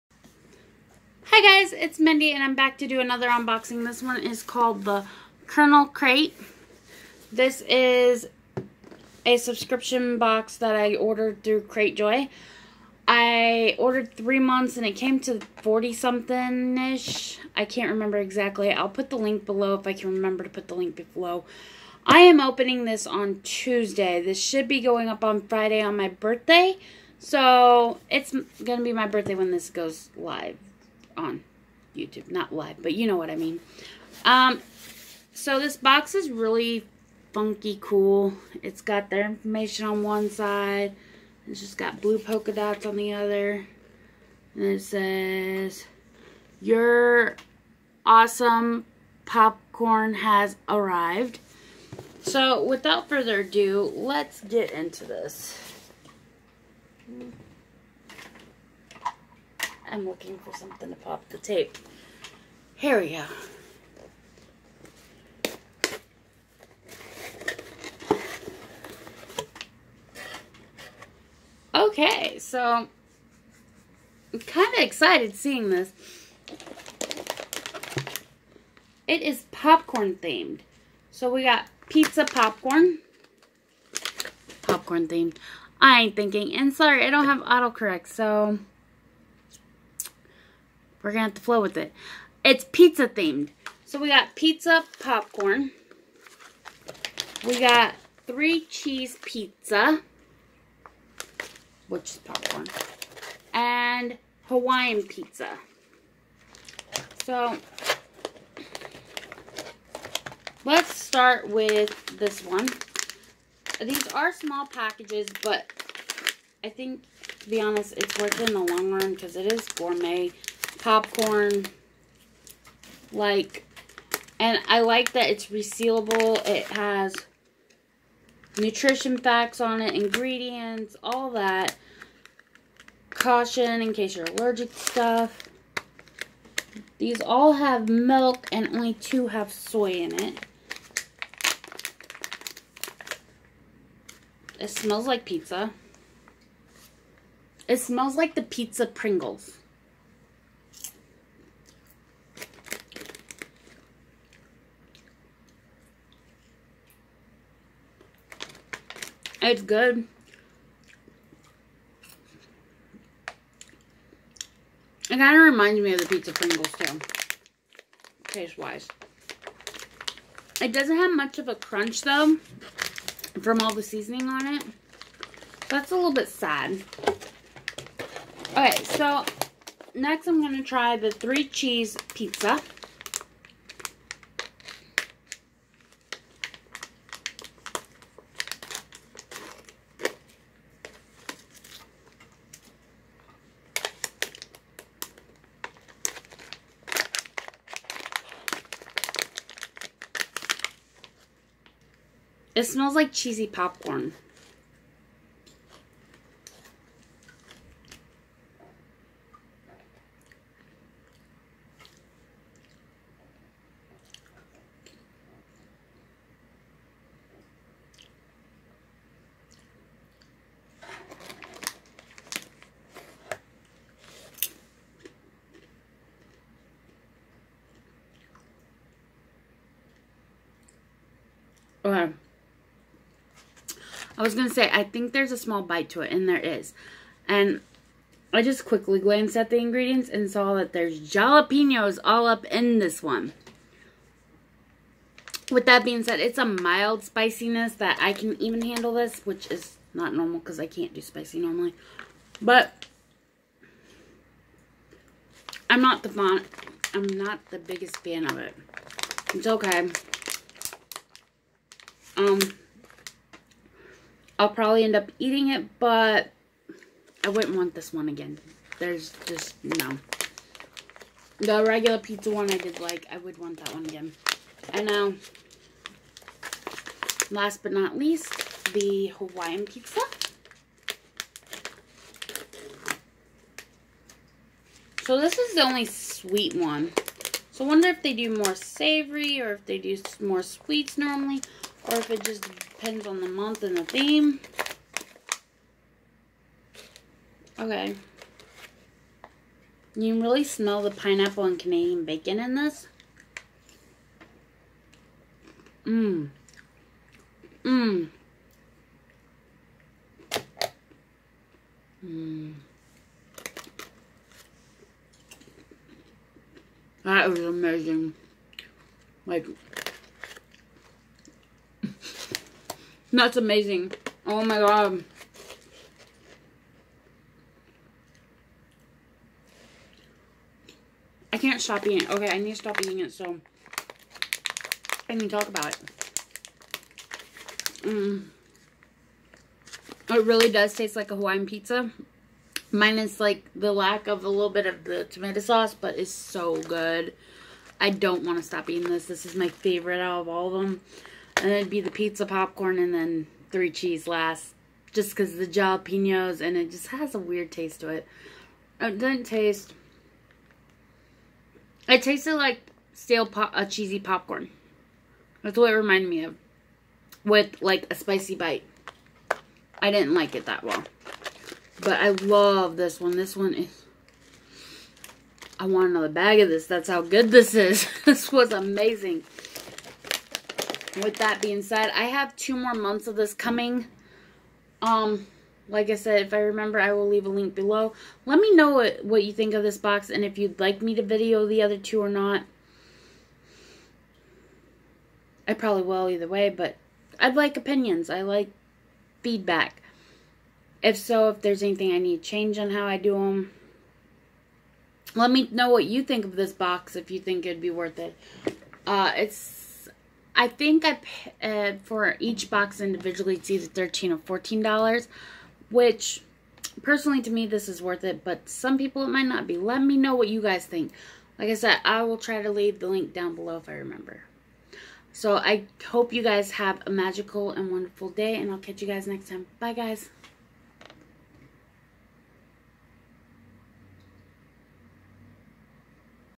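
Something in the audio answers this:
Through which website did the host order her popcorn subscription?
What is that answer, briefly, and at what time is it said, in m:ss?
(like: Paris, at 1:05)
Cratejoy, at 0:11.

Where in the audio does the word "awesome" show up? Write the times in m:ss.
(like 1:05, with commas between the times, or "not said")
0:48.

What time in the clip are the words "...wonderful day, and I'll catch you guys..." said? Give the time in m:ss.
7:07.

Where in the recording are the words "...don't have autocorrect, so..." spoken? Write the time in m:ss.
1:27.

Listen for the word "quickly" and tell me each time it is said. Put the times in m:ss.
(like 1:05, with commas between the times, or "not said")
3:58.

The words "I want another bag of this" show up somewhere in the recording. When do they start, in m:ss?
6:15.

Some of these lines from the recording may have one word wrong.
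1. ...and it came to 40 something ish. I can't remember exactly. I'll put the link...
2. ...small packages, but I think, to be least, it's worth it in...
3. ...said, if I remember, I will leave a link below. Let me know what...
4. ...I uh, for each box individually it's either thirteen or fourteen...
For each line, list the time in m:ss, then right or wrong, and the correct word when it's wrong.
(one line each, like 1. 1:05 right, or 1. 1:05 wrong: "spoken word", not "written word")
1. 0:14 right
2. 1:54 wrong: "honest", not "least"
3. 6:25 right
4. 6:50 right.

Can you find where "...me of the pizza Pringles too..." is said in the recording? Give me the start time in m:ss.
2:45.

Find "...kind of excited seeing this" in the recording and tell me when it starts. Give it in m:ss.
1:14.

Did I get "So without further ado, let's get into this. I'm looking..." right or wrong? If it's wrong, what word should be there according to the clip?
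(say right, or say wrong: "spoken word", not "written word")
right.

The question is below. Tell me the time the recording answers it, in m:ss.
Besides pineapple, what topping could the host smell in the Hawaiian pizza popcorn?
5:01.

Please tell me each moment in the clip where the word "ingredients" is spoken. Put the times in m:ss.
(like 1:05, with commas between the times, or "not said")
2:09, 3:59.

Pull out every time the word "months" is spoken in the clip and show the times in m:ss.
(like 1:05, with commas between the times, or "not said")
0:14, 4:53, 6:22.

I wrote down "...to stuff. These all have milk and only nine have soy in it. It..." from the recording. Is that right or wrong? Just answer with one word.
wrong.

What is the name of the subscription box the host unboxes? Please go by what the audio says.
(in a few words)
Kernel Crate.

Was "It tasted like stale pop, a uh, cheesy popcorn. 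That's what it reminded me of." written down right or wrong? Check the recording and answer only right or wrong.
right.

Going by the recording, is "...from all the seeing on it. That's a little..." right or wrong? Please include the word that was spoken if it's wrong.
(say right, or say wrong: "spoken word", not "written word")
wrong: "seasoning", not "seeing".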